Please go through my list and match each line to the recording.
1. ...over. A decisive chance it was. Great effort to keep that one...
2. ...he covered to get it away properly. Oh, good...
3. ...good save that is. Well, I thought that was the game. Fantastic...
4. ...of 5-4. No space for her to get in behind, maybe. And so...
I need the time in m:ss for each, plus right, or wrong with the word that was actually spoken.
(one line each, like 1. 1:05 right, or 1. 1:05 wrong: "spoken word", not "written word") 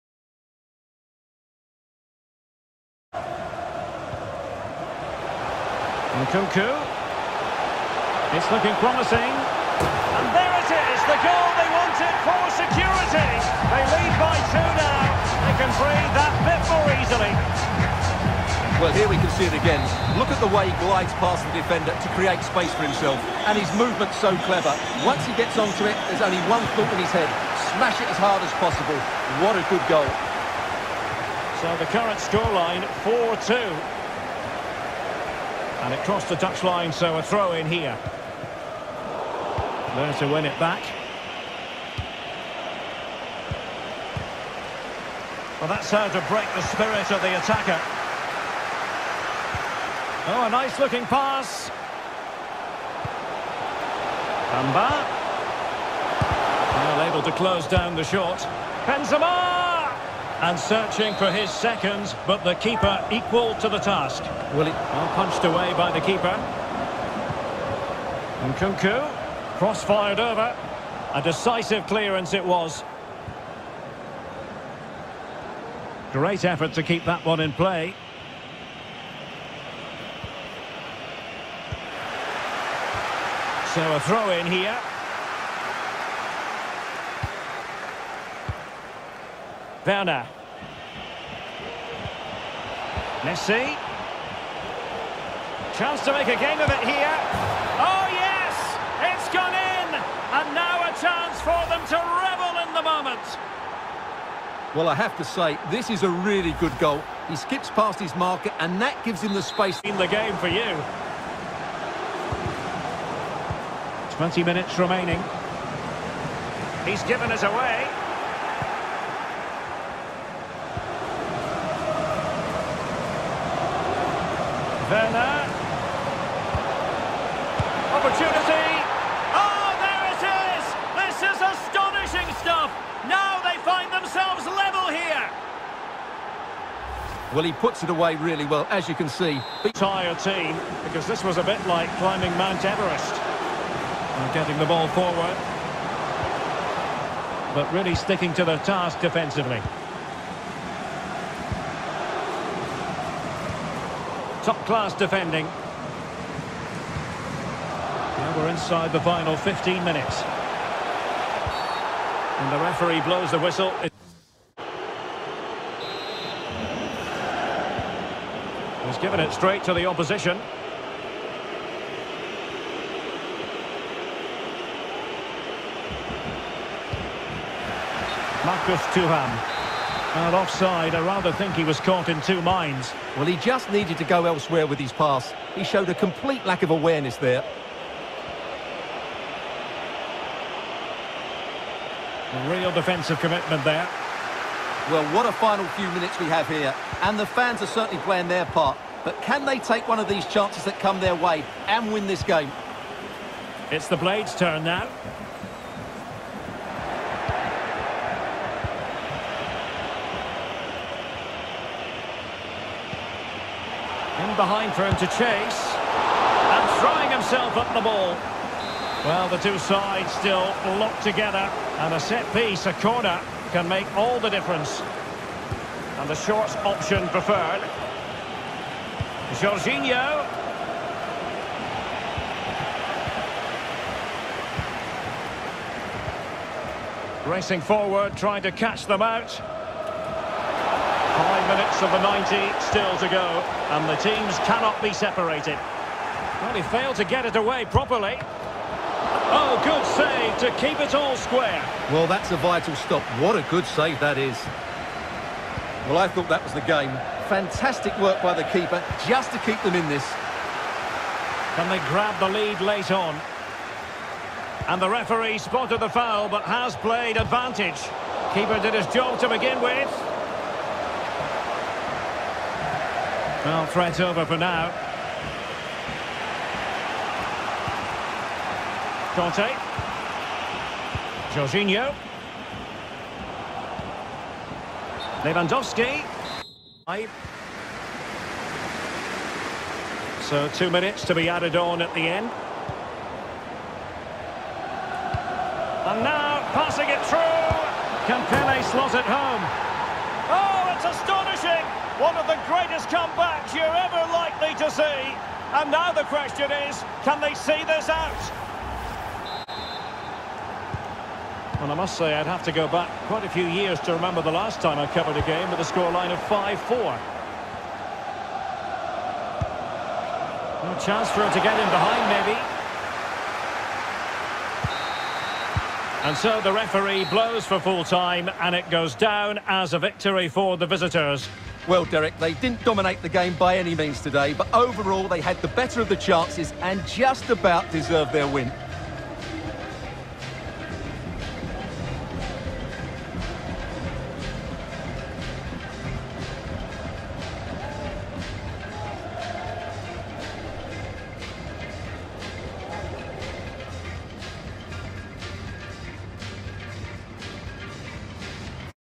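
1. 1:10 wrong: "clearance", not "chance"
2. 4:06 wrong: "failed", not "covered"
3. 4:13 right
4. 5:16 wrong: "chance", not "space".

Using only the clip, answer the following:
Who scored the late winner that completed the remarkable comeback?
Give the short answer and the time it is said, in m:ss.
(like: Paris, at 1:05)
Campele, at 4:58.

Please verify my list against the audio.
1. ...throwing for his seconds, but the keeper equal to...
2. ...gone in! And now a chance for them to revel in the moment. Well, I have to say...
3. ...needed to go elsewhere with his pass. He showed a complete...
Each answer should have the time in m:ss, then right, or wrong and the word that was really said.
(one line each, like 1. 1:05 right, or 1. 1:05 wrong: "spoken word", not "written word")
1. 1:00 wrong: "searching", not "throwing"
2. 1:39 right
3. 3:03 right.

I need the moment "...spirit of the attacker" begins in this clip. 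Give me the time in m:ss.
0:46.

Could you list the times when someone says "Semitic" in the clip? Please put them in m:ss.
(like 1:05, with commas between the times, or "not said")
not said.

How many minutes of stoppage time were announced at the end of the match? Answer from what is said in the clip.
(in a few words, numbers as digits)
2.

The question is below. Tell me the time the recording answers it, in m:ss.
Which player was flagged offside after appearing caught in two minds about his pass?
2:58.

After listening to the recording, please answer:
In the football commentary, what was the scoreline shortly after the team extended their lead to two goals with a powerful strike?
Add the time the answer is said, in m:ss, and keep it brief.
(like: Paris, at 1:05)
4-2, at 0:33.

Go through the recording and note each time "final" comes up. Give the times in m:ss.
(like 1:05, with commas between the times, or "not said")
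2:39, 3:15.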